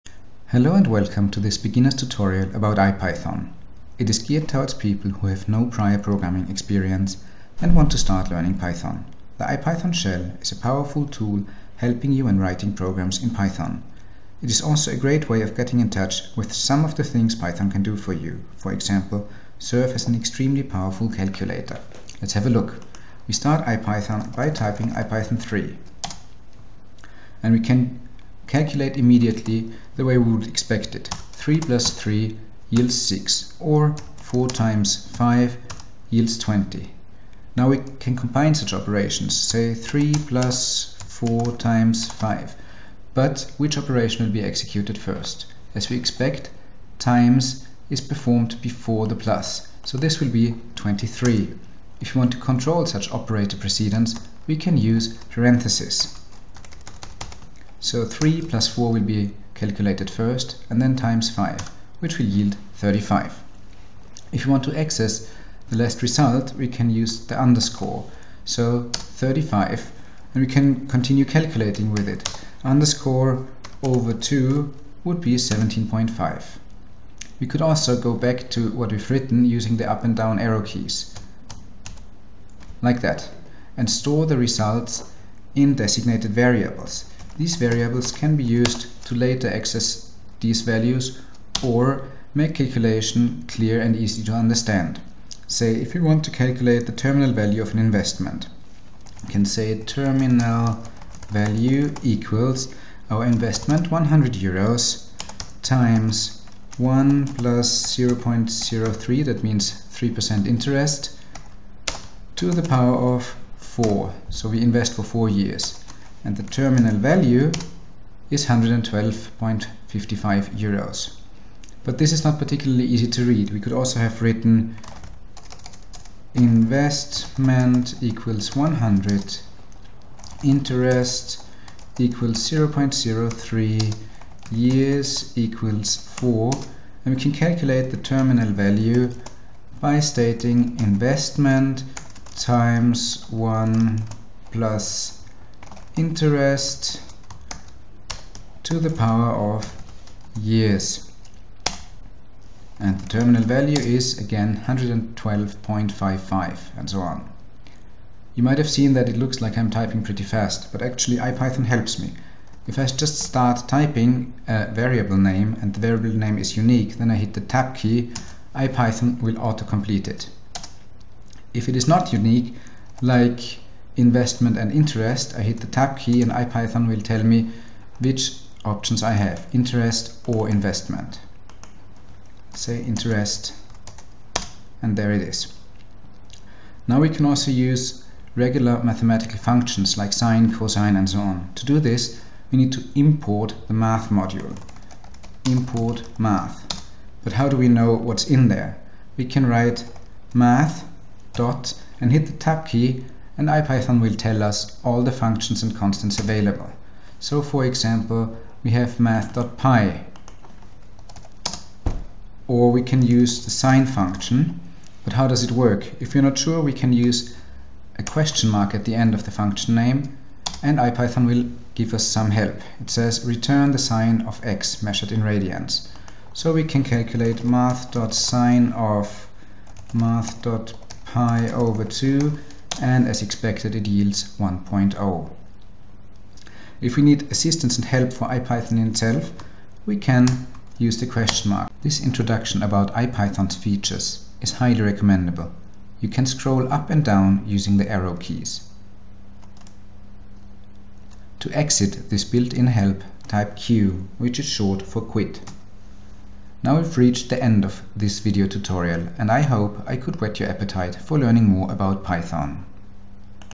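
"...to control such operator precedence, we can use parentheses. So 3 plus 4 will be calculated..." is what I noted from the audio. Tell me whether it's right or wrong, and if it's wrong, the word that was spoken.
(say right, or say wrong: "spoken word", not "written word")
right.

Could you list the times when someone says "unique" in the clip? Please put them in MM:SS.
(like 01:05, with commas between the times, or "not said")
02:46, 02:52.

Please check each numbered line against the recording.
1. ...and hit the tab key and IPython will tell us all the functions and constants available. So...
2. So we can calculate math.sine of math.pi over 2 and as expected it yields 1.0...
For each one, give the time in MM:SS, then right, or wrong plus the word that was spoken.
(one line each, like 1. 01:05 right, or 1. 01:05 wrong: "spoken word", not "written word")
1. 03:22 right
2. 03:46 right.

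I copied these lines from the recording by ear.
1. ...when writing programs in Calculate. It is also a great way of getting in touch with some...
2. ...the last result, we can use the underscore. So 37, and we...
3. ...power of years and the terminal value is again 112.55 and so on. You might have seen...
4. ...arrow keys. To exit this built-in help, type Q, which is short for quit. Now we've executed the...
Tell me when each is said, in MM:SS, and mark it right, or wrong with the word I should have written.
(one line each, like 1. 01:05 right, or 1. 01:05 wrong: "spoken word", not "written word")
1. 00:12 wrong: "Python", not "Calculate"
2. 01:05 wrong: "35", not "37"
3. 02:28 right
4. 04:07 wrong: "reached", not "executed".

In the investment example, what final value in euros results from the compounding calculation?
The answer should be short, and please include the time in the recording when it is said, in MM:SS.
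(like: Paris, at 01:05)
112.55 euros, at 01:58.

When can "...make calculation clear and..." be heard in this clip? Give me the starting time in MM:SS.
01:32.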